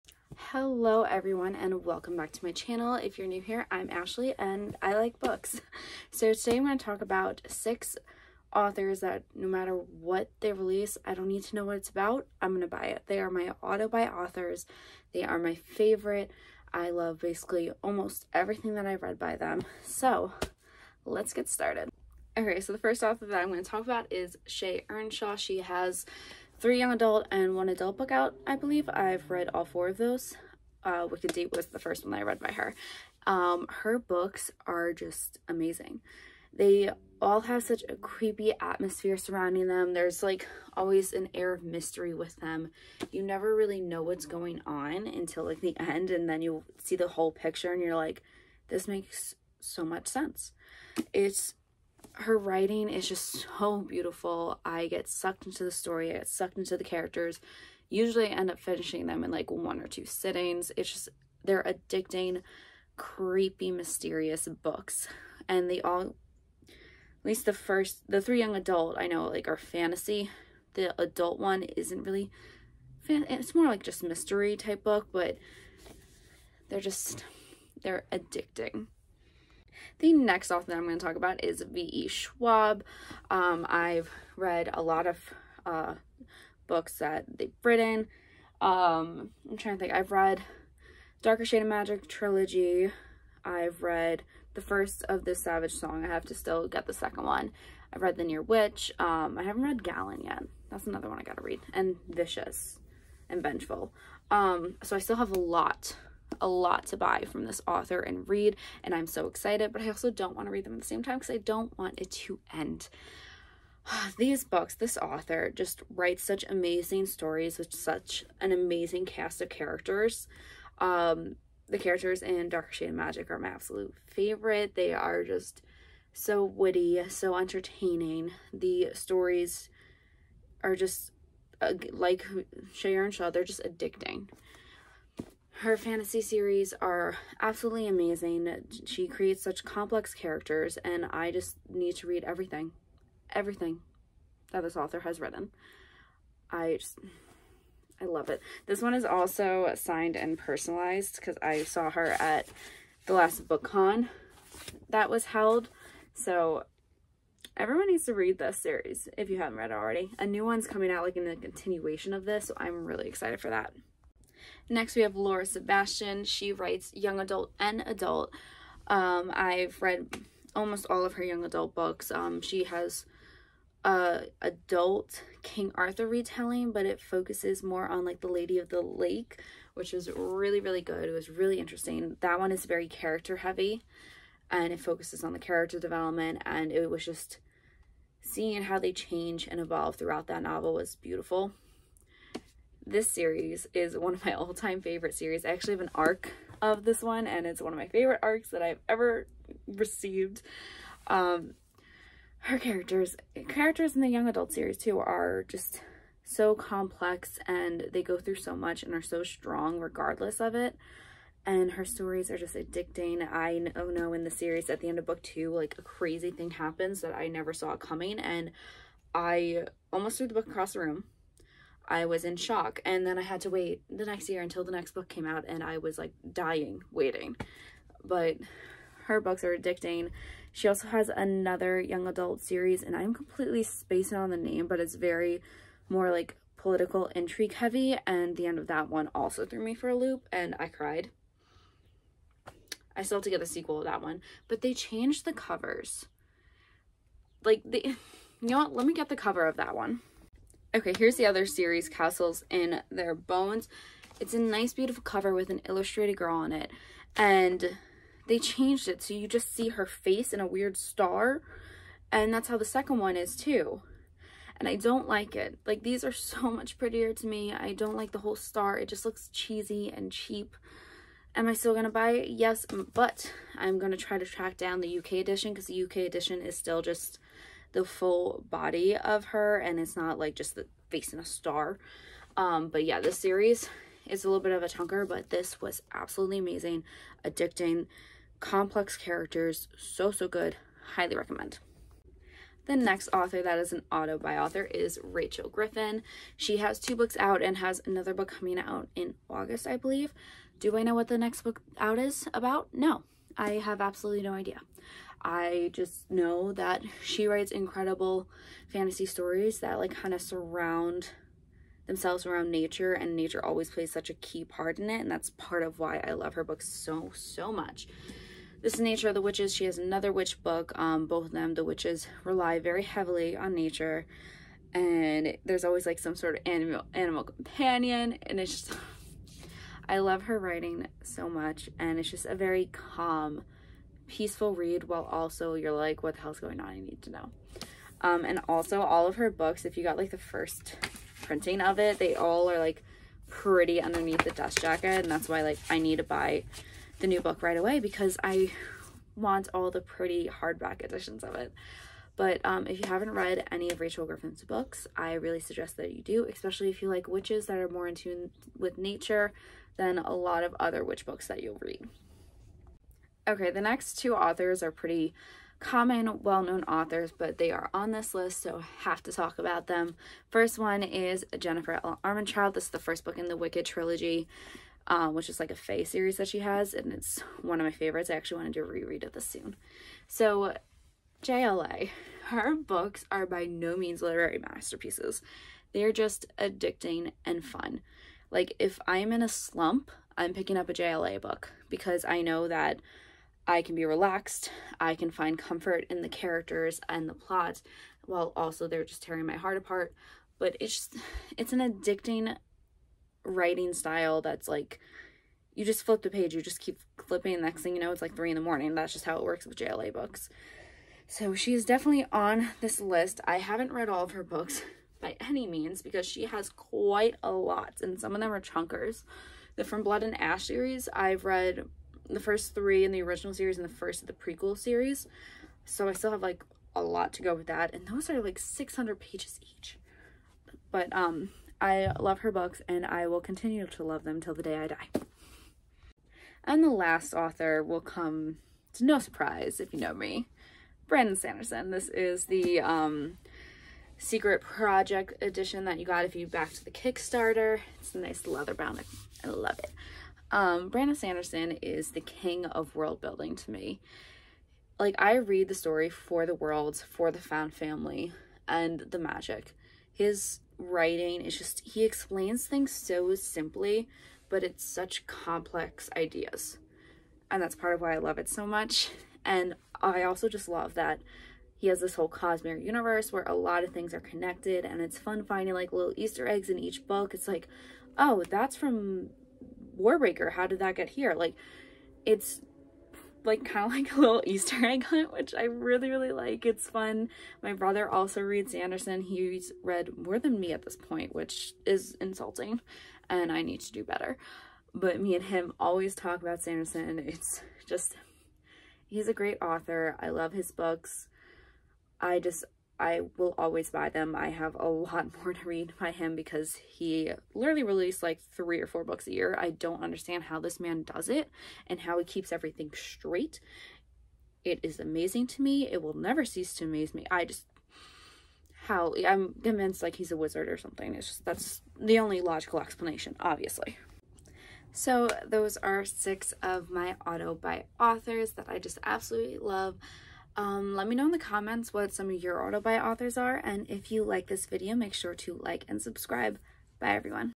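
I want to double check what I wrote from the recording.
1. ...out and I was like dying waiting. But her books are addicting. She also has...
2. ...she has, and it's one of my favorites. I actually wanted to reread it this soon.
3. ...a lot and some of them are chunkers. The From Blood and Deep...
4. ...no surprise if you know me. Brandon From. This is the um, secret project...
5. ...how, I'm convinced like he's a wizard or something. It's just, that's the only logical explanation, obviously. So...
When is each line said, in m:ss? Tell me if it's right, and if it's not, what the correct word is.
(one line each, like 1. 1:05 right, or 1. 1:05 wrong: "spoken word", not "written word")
1. 3:45 right
2. 6:16 right
3. 6:57 wrong: "Ash", not "Deep"
4. 7:18 wrong: "Sanderson", not "From"
5. 8:38 right.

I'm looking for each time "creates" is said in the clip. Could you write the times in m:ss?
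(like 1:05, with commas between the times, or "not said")
2:19.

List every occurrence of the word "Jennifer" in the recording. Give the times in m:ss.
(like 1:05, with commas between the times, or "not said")
6:11.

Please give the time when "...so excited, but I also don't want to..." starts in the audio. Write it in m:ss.
1:49.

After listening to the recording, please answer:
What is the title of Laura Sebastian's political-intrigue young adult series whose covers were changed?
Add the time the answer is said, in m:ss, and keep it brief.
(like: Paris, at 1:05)
Castles in Their Bones, at 4:11.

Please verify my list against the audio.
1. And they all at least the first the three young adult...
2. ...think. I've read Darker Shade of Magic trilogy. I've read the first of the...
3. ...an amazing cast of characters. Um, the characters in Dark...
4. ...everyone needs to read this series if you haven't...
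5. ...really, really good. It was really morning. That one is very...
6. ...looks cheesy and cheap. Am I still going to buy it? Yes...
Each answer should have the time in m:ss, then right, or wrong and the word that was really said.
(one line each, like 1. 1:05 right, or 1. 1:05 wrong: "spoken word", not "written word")
1. 1:05 right
2. 1:29 right
3. 1:58 right
4. 2:37 right
5. 3:00 wrong: "interesting", not "morning"
6. 4:29 right.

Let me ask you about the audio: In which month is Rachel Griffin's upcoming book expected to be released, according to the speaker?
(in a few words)
August.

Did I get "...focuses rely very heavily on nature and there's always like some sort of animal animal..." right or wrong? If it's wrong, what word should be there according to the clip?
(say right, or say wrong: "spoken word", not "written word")
wrong: "witches", not "focuses".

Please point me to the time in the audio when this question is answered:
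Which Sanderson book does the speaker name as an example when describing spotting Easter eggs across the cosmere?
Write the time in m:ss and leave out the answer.
7:59.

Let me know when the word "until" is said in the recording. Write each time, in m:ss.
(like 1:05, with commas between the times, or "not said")
0:45, 3:44.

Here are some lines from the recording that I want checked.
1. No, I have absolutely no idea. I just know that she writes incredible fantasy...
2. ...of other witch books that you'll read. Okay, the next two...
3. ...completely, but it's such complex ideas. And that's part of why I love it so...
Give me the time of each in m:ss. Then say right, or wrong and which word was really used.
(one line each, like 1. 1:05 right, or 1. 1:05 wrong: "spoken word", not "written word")
1. 5:02 right
2. 6:00 right
3. 7:43 wrong: "simply", not "completely".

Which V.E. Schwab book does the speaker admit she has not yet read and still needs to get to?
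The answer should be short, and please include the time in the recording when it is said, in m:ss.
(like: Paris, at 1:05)
Gallant, at 1:39.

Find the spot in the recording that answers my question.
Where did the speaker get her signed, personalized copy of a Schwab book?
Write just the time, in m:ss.
2:33.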